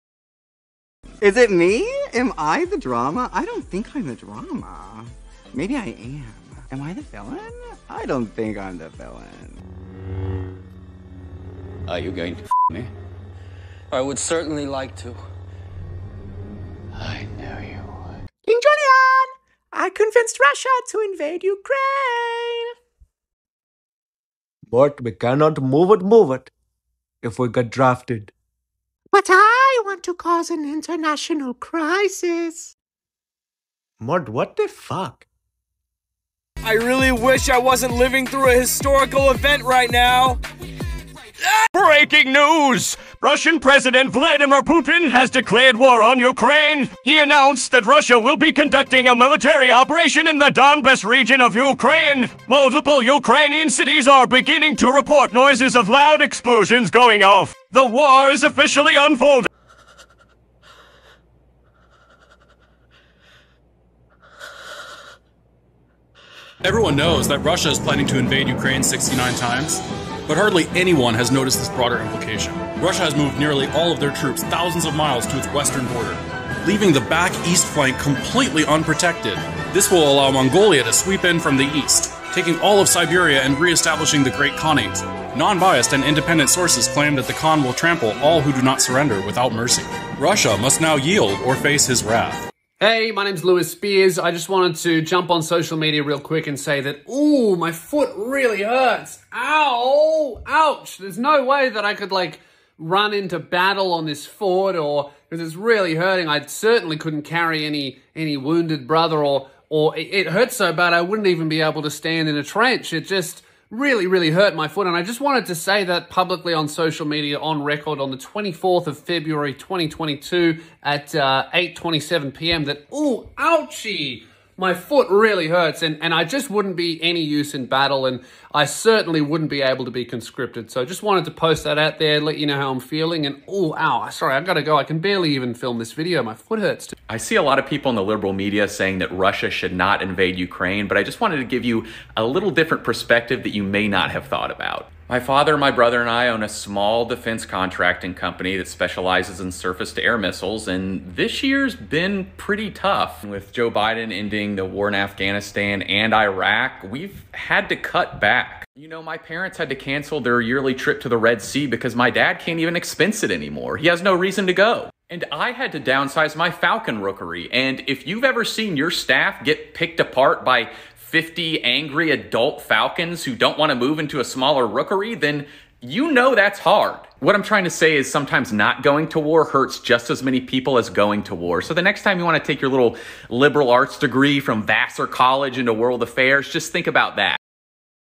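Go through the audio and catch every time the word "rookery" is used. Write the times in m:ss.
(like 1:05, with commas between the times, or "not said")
2:47, 2:54.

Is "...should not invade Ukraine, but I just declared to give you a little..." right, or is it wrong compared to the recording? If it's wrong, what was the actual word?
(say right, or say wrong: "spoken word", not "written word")
wrong: "wanted", not "declared".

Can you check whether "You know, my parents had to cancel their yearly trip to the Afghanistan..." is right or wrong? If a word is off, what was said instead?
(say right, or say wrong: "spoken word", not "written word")
wrong: "Red", not "Afghanistan".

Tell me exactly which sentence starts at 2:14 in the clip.
I can barely even film this video.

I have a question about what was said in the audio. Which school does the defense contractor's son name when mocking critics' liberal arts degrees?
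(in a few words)
Vassar College.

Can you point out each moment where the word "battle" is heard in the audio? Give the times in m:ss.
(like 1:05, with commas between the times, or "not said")
1:43, 2:07.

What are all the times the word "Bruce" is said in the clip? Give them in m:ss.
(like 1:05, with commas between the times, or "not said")
not said.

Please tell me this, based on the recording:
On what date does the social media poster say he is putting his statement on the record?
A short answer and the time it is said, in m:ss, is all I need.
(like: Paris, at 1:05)
24 February 2022, at 1:58.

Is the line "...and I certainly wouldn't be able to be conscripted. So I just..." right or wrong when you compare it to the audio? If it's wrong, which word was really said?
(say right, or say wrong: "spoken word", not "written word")
right.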